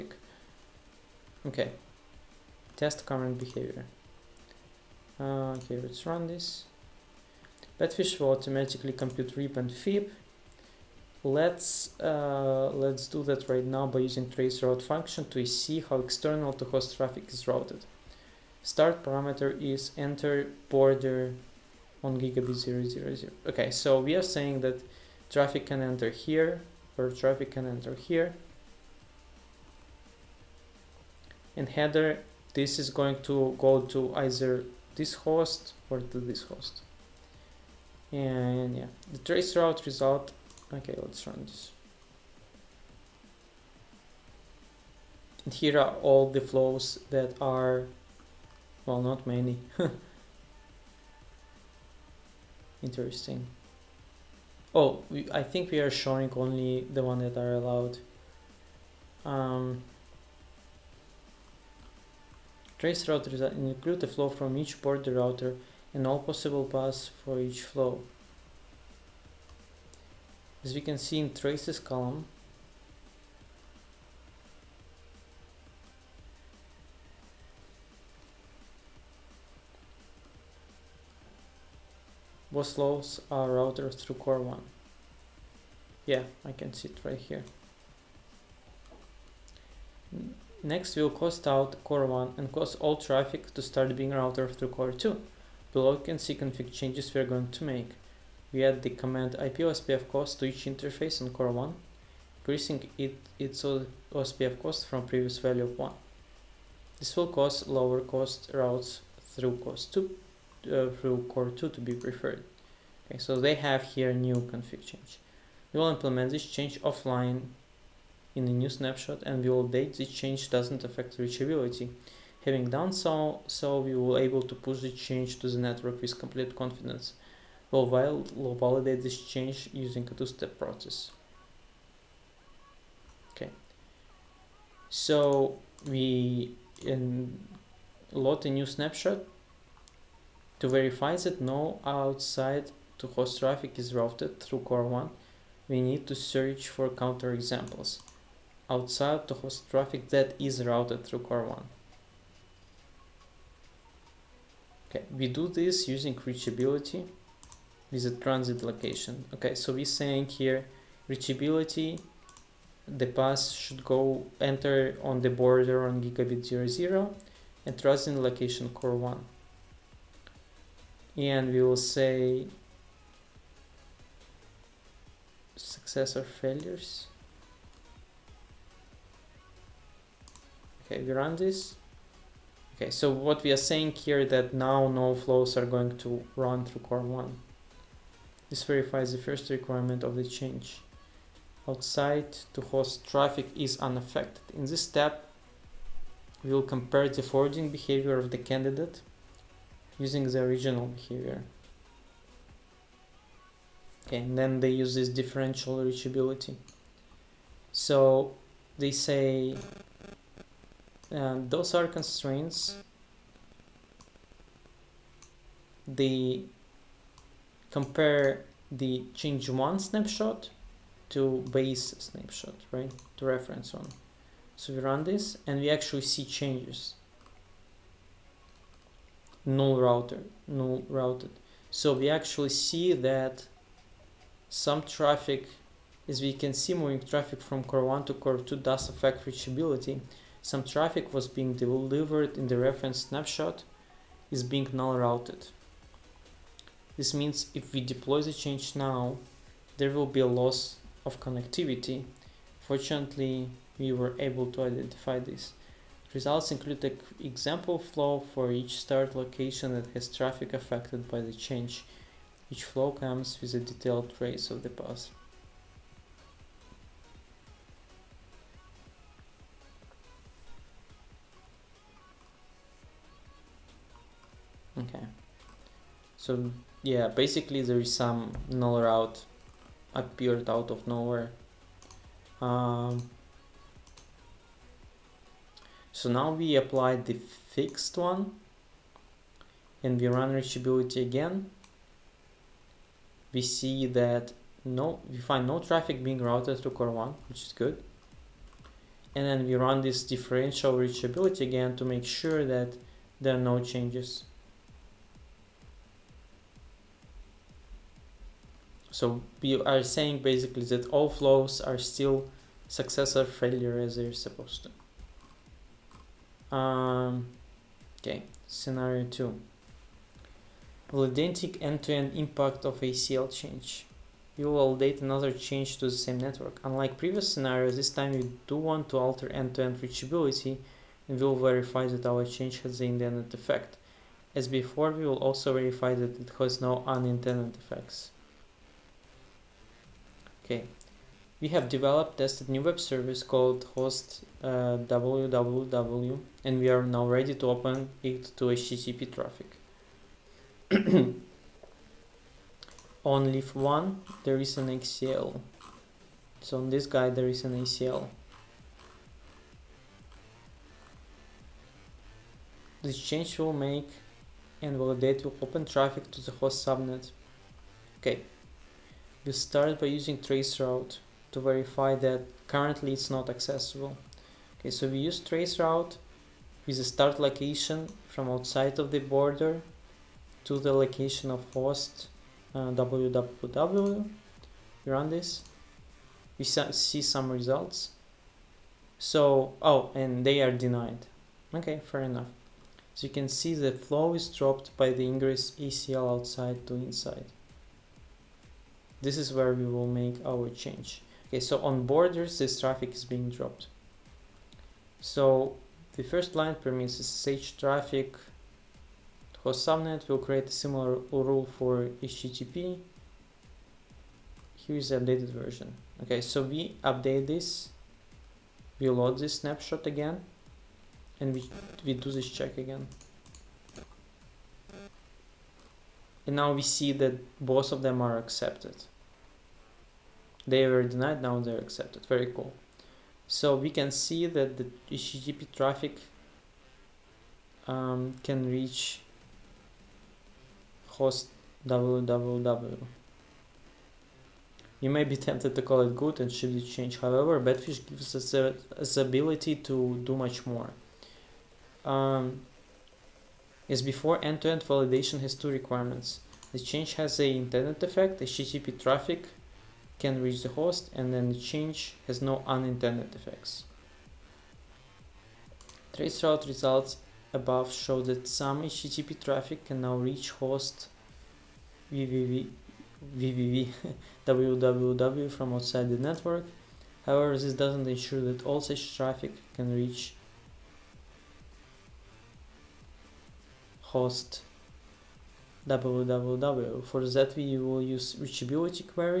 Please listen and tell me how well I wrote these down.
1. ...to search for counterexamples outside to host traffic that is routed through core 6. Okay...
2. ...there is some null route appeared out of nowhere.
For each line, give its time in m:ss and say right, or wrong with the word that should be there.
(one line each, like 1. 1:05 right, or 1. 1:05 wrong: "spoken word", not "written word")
1. 2:26 wrong: "1", not "6"
2. 4:37 right.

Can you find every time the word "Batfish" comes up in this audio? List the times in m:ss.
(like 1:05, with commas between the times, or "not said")
0:07, 7:27.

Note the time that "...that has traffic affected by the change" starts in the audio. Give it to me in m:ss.
4:19.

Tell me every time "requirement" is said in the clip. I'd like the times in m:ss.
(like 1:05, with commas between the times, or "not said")
3:09, 7:35.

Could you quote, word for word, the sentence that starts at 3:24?
Okay, and then they use this differential reachability.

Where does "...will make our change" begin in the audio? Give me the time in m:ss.
6:39.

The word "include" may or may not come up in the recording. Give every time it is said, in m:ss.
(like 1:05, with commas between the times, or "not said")
1:03, 4:16.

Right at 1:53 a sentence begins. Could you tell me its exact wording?
Okay, so they have here new config change.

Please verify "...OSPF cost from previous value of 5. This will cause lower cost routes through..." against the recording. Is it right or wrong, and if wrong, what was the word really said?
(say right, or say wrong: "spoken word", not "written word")
wrong: "1", not "5".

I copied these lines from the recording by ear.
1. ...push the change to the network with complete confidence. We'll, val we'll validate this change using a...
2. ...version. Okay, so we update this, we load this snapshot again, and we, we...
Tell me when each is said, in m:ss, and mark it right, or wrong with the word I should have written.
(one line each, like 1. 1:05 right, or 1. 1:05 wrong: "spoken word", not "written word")
1. 2:04 right
2. 6:55 right.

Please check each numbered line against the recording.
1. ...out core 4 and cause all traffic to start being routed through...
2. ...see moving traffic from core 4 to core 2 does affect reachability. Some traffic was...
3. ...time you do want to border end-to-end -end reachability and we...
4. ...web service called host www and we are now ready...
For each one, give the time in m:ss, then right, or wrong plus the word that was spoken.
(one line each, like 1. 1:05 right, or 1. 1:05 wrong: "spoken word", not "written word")
1. 1:31 wrong: "1", not "4"
2. 3:56 wrong: "1", not "4"
3. 5:27 wrong: "alter", not "border"
4. 5:42 right.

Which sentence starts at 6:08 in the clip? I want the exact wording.
Okay, we start by using traceroute to verify that currently it's not accessible.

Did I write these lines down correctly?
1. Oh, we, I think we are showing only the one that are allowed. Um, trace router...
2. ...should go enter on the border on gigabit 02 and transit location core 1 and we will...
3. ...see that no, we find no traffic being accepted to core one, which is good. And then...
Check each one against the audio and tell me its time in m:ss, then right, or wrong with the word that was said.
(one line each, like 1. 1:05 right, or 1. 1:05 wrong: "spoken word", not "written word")
1. 0:54 right
2. 2:43 wrong: "00", not "02"
3. 4:53 wrong: "routed", not "accepted".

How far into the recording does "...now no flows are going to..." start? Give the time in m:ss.
3:04.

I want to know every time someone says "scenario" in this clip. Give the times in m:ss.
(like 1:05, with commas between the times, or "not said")
5:18, 5:27.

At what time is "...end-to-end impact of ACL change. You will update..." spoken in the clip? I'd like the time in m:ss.
5:21.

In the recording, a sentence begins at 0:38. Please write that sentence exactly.
And yeah, the trace route result.